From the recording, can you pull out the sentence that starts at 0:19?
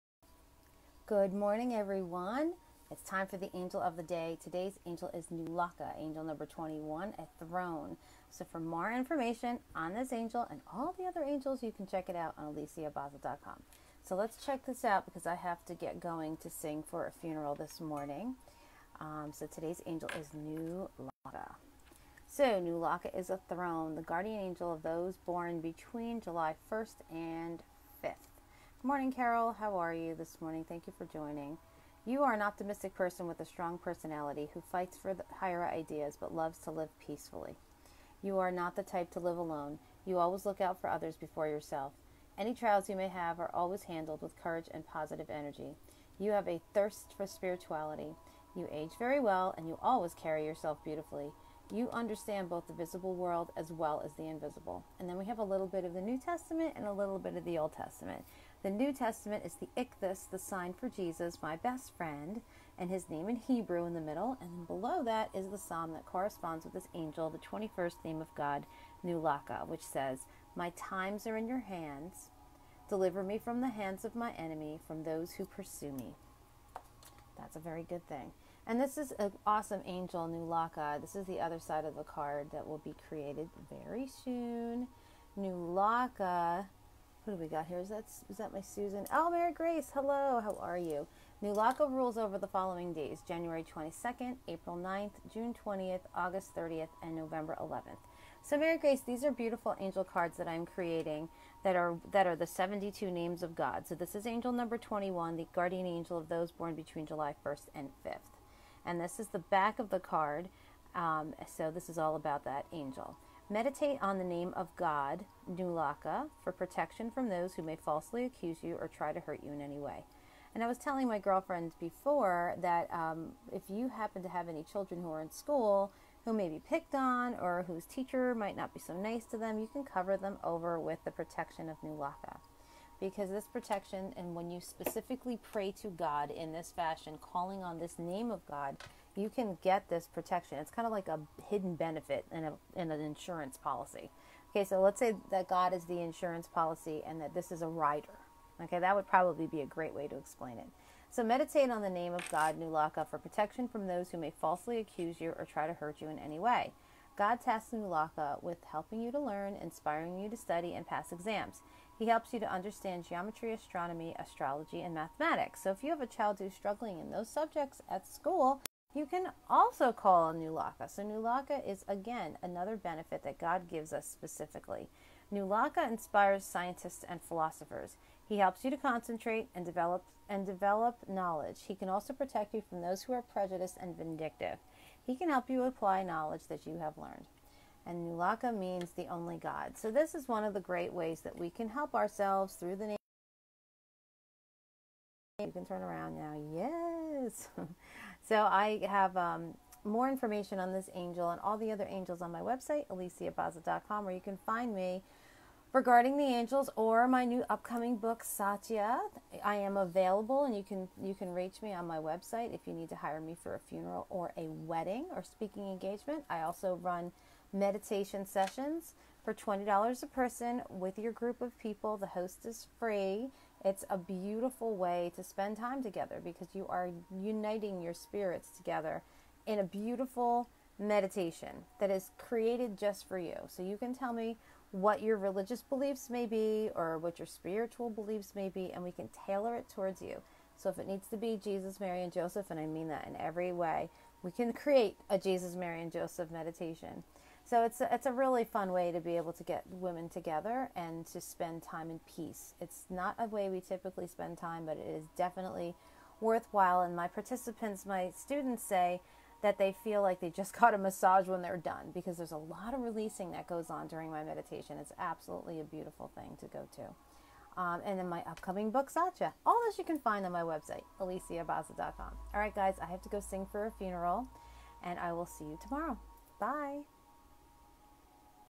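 Um, so, today's angel is Nulaka.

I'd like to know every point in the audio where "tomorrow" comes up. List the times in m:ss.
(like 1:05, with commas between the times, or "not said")
4:35.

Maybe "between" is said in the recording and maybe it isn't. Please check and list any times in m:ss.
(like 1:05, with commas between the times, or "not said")
0:25, 1:46.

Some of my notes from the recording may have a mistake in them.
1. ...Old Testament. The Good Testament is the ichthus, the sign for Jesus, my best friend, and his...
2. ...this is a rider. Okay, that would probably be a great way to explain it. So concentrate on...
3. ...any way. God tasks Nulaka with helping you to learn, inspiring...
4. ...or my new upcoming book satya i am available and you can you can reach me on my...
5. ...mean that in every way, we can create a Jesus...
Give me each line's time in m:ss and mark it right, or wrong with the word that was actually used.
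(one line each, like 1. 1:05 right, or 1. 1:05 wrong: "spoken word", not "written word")
1. 0:57 wrong: "New", not "Good"
2. 2:27 wrong: "meditate", not "concentrate"
3. 2:36 right
4. 3:26 right
5. 4:02 right.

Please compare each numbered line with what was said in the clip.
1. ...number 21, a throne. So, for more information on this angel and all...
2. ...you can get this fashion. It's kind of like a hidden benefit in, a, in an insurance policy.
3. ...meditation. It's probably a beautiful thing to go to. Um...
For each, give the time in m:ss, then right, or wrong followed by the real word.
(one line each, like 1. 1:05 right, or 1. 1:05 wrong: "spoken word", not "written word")
1. 0:06 right
2. 2:19 wrong: "protection", not "fashion"
3. 4:24 wrong: "absolutely", not "probably".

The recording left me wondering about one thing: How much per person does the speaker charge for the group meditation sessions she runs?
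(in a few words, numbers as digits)
$20.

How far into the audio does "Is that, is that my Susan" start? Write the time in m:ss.
1:27.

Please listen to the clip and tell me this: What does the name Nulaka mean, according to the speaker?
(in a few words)
The only God.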